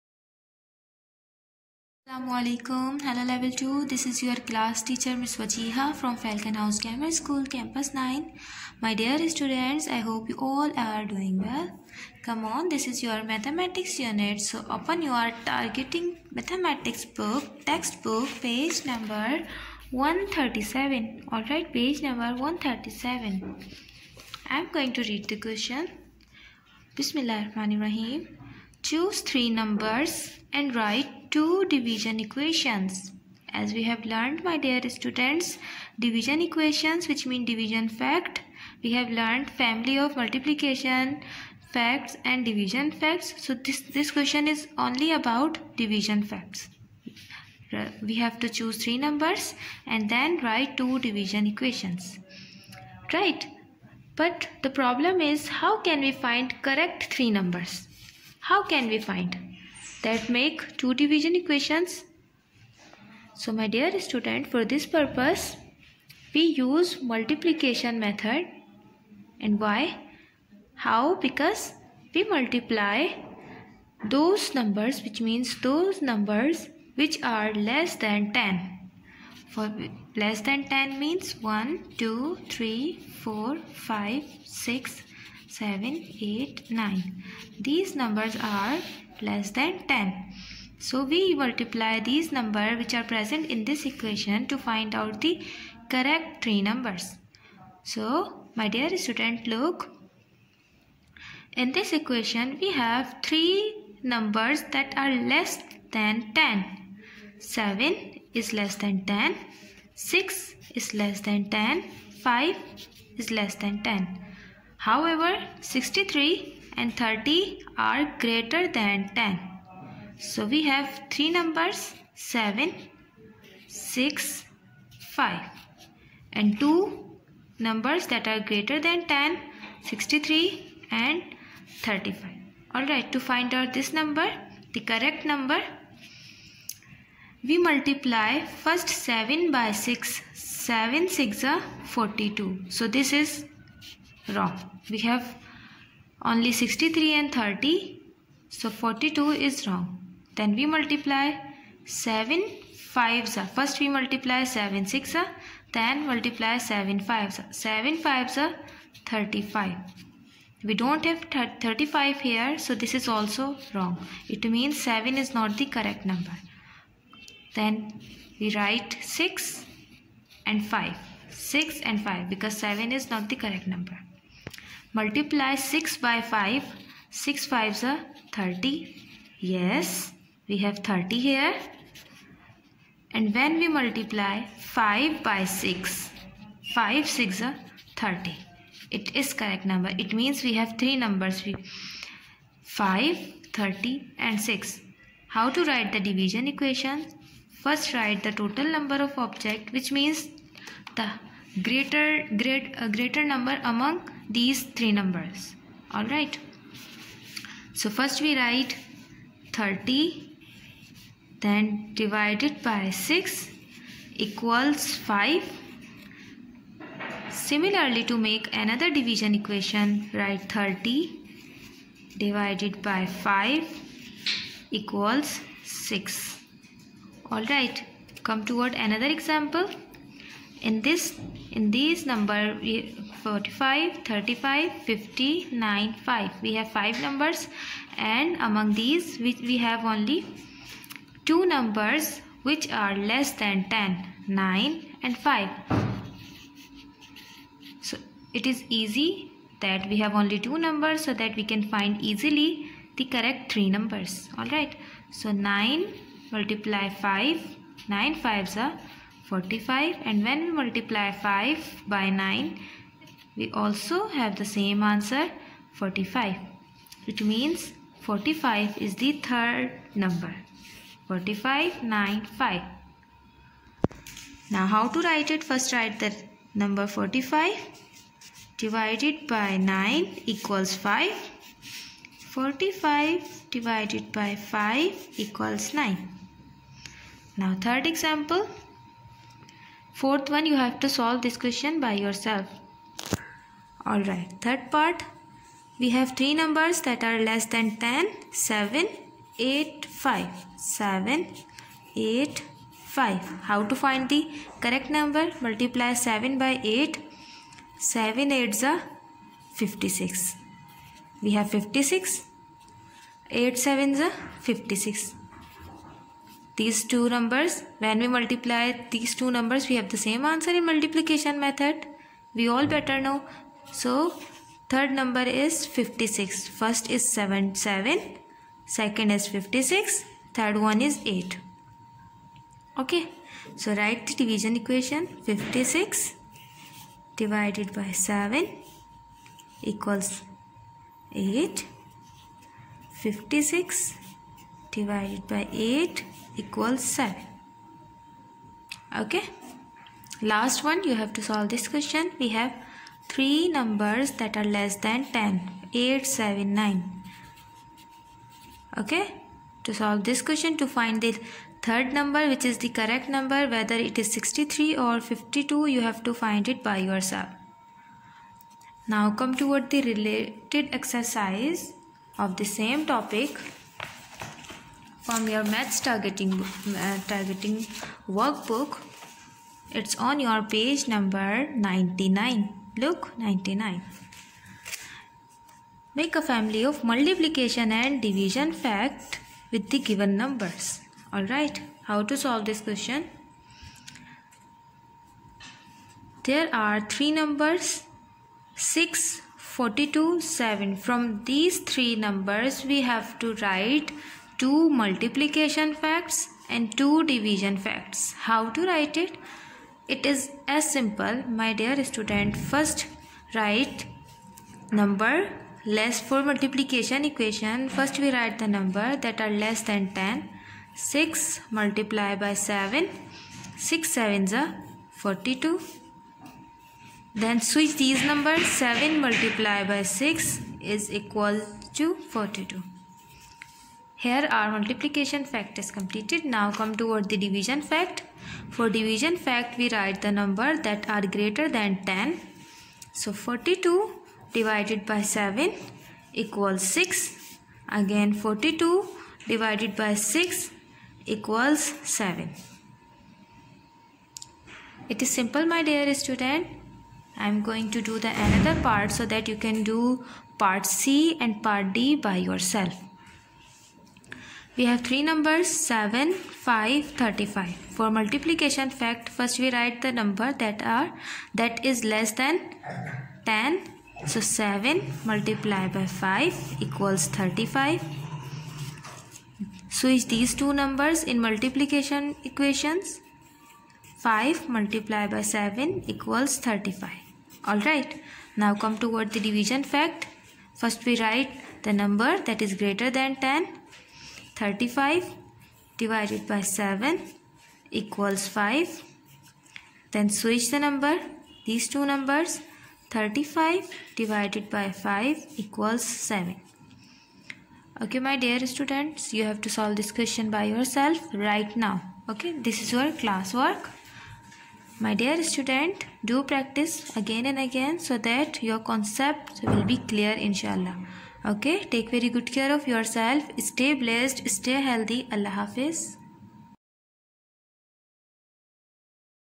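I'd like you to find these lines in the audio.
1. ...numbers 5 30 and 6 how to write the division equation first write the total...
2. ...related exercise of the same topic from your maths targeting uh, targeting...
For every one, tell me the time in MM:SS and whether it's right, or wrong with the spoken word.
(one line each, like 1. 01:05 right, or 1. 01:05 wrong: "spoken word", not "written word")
1. 03:11 right
2. 06:09 right.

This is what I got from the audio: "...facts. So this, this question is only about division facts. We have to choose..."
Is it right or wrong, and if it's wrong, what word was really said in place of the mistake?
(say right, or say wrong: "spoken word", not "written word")
right.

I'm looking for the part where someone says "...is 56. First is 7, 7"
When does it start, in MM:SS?
05:25.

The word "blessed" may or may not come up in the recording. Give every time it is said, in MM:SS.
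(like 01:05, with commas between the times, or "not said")
08:43.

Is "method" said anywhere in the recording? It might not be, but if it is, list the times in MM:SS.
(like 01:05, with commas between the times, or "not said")
01:07, 05:21.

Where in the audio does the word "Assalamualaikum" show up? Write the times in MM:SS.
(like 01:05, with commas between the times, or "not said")
00:02.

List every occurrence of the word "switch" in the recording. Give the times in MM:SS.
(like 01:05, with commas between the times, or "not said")
07:07, 07:59, 08:20.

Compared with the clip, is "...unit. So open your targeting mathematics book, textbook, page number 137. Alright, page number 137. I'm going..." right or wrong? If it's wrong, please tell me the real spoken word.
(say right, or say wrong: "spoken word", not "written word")
right.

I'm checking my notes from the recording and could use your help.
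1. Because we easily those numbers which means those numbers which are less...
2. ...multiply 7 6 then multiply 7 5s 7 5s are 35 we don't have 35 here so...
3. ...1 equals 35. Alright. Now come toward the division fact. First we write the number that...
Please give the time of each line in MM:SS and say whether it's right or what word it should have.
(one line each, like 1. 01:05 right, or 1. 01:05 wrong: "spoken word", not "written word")
1. 01:11 wrong: "multiply", not "easily"
2. 02:33 right
3. 08:05 wrong: "7", not "1".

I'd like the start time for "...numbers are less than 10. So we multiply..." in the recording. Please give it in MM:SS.
01:27.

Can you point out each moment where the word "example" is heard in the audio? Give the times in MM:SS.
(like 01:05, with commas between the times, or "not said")
03:49, 04:47.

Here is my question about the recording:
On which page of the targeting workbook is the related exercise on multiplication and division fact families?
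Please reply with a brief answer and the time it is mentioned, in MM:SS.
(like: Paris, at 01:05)
99, at 06:20.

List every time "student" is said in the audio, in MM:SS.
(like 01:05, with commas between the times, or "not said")
00:09, 00:34, 01:03, 01:38, 06:51, 07:35, 08:28, 08:35.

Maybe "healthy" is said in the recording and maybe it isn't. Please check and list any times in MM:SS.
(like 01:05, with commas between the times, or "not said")
08:44.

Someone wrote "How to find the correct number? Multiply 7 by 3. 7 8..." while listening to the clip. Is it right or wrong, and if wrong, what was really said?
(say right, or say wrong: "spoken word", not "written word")
wrong: "8", not "3".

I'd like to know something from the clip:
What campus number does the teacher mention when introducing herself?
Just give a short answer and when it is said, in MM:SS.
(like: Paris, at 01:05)
9, at 00:07.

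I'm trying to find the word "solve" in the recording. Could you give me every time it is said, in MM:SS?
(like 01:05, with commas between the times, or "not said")
04:50, 05:51, 05:59, 06:32, 08:29.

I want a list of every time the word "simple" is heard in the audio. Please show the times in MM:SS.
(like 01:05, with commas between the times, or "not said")
06:50, 07:35.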